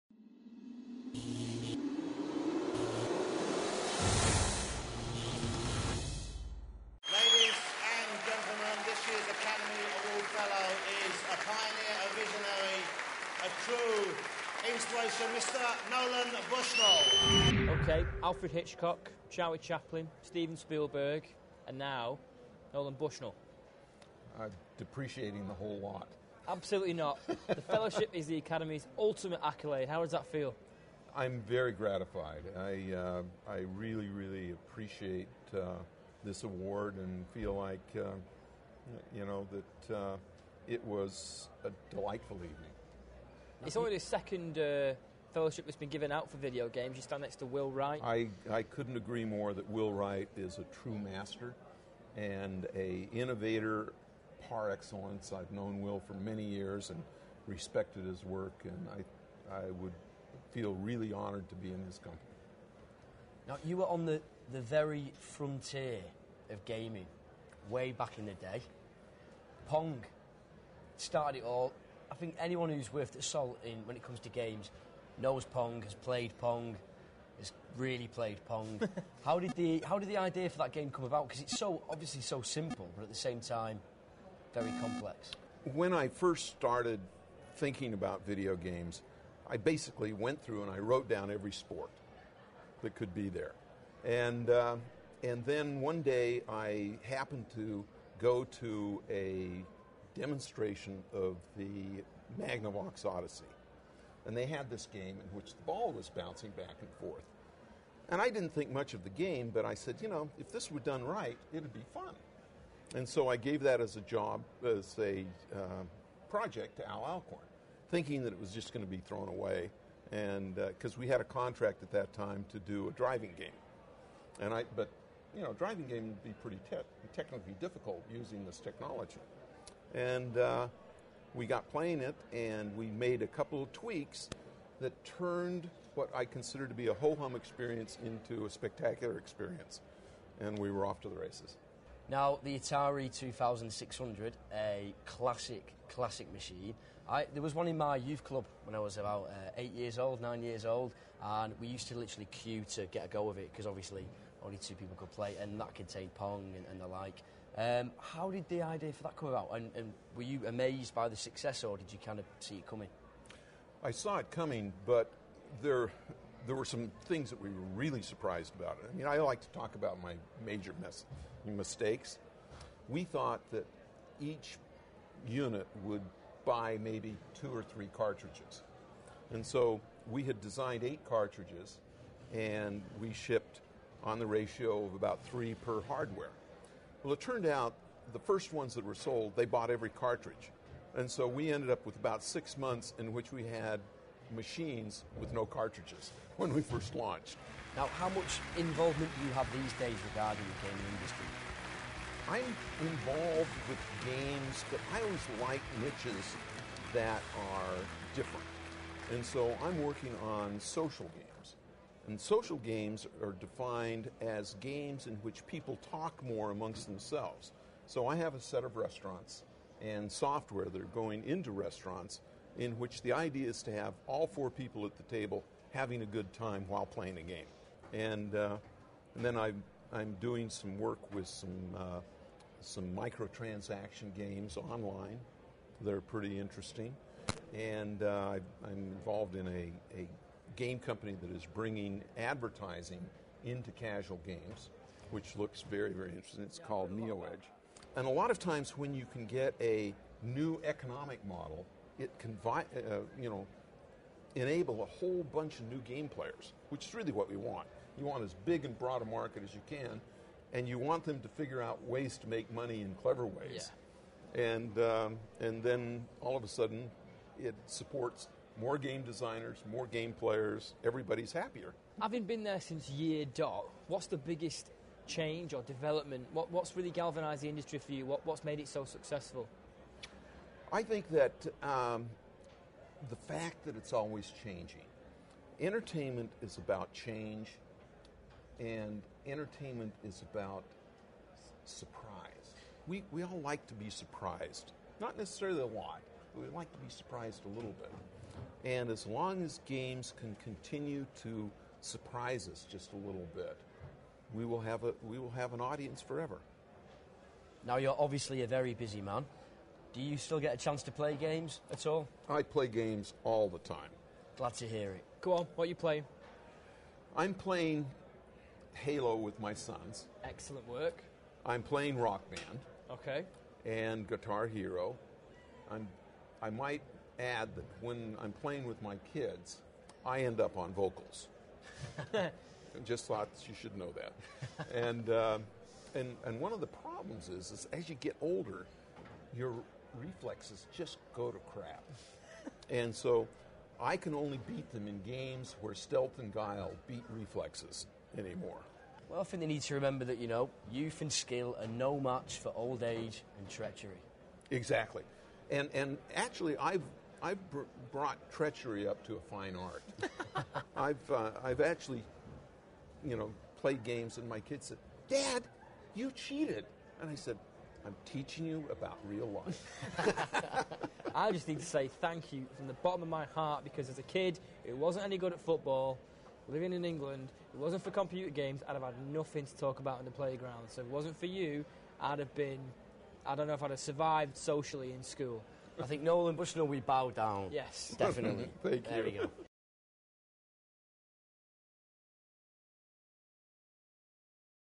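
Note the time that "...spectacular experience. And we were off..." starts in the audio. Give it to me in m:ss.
2:18.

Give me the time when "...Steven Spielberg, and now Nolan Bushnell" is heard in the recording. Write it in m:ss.
0:20.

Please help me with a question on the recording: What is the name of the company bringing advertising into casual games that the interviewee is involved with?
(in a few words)
NeoEdge.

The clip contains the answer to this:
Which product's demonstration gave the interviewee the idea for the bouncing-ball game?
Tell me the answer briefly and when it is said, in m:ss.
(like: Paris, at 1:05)
Magnavox Odyssey, at 1:42.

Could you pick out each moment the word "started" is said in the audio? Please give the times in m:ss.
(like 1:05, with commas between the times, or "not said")
1:10, 1:26.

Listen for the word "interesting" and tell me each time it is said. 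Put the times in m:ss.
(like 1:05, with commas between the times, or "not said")
3:56, 4:06.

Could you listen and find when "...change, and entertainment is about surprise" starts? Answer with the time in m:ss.
4:46.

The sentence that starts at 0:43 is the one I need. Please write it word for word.
It's only the second uh, fellowship that's been given out for video games.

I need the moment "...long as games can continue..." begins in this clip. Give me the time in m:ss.
4:59.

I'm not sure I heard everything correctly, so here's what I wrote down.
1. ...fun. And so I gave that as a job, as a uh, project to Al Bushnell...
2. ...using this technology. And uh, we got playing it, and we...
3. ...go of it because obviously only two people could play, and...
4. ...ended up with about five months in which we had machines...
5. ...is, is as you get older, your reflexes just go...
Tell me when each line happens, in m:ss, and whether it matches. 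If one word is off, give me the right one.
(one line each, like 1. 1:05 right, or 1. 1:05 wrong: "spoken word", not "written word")
1. 1:51 wrong: "Alcorn", not "Bushnell"
2. 2:08 right
3. 2:33 right
4. 3:11 wrong: "six", not "five"
5. 5:37 right.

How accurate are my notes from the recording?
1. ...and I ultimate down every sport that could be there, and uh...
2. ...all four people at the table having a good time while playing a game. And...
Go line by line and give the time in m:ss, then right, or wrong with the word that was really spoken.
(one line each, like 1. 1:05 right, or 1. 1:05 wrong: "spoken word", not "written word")
1. 1:30 wrong: "wrote", not "ultimate"
2. 3:44 right.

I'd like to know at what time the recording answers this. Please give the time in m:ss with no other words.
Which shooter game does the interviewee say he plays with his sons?
5:18.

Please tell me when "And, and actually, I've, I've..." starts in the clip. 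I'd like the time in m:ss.
5:55.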